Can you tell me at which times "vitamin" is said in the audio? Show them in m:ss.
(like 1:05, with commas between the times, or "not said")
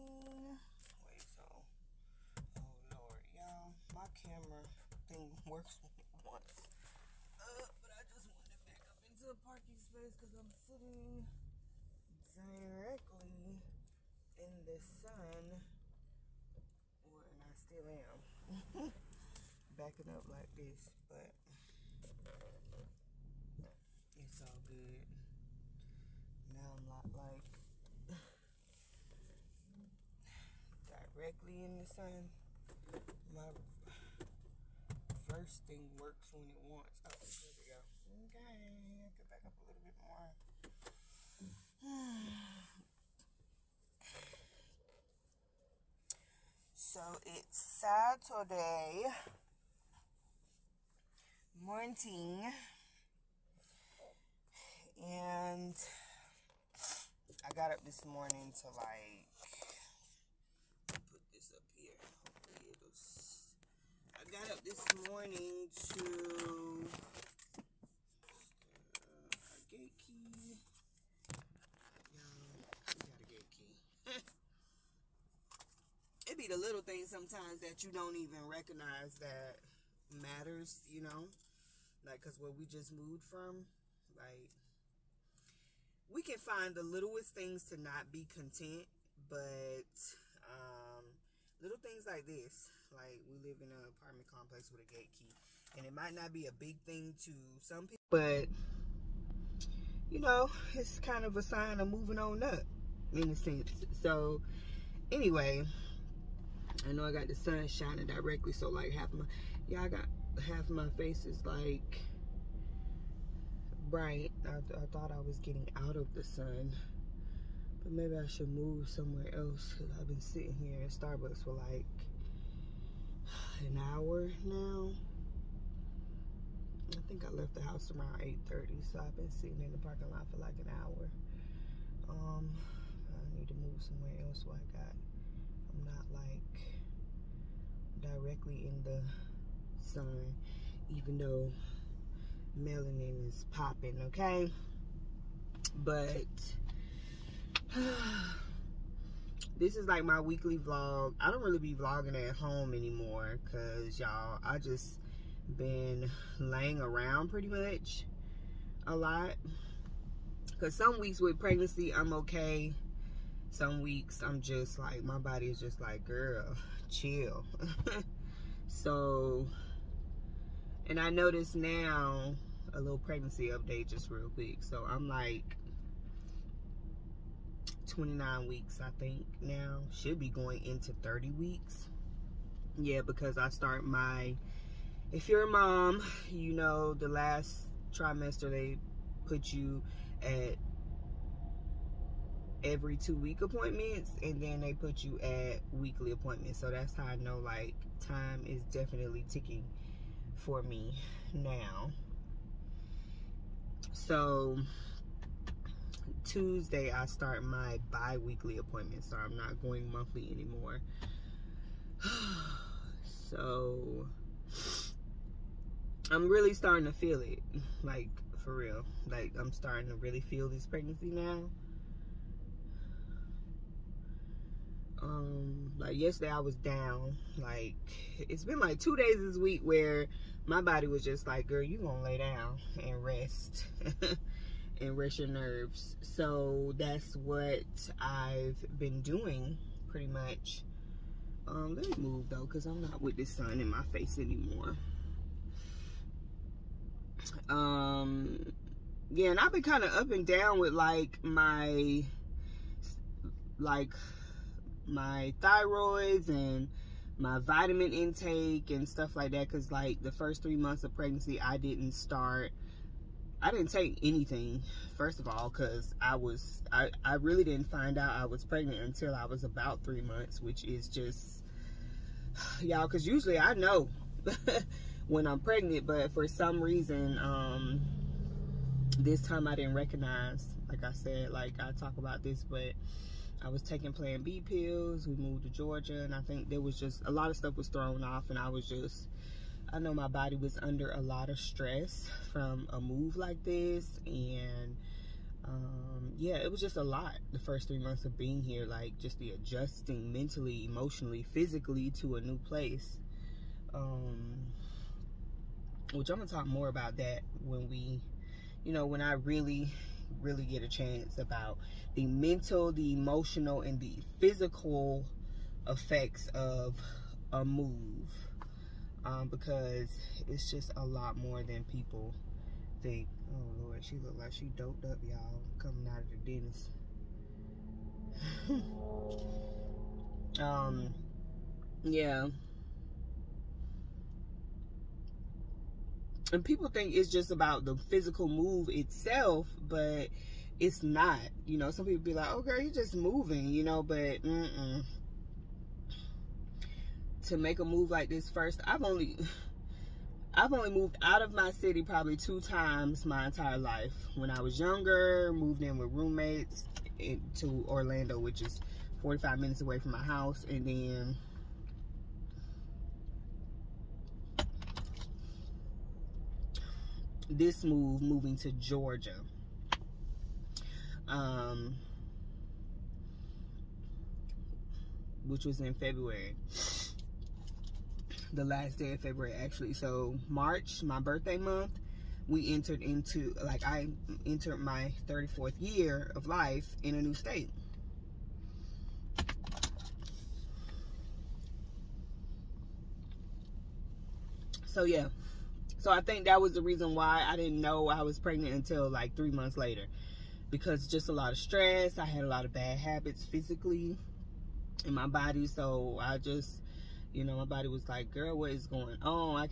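4:17.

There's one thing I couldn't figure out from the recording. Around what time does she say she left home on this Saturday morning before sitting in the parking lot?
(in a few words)
8:30.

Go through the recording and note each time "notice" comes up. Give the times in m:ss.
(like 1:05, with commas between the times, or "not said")
2:51.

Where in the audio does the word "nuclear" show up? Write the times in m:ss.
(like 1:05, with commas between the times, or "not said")
not said.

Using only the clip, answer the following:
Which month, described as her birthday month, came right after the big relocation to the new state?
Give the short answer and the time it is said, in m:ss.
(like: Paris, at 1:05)
March, at 6:20.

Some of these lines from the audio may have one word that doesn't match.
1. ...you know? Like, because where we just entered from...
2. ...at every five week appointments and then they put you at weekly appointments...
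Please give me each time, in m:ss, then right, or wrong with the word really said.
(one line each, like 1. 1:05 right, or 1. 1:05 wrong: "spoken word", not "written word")
1. 1:20 wrong: "moved", not "entered"
2. 3:10 wrong: "two", not "five".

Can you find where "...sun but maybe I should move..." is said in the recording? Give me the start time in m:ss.
1:56.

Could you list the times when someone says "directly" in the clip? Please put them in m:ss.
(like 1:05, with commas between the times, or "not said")
0:12, 0:31, 1:48, 2:18.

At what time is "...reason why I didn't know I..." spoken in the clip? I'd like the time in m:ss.
6:36.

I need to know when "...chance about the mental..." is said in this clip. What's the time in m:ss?
5:10.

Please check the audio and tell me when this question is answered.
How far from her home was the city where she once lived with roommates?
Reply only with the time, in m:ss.
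5:59.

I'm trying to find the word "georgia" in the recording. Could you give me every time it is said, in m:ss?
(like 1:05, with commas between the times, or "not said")
4:45, 6:08.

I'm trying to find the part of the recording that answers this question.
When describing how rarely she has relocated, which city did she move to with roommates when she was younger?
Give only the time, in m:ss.
5:57.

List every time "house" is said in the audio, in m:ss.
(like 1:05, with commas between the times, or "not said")
2:07, 6:00.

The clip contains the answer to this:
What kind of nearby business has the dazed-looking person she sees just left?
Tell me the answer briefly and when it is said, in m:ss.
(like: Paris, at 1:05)
the dentist, at 5:26.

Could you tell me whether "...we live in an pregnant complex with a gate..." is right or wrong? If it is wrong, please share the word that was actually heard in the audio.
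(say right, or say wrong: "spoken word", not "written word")
wrong: "apartment", not "pregnant".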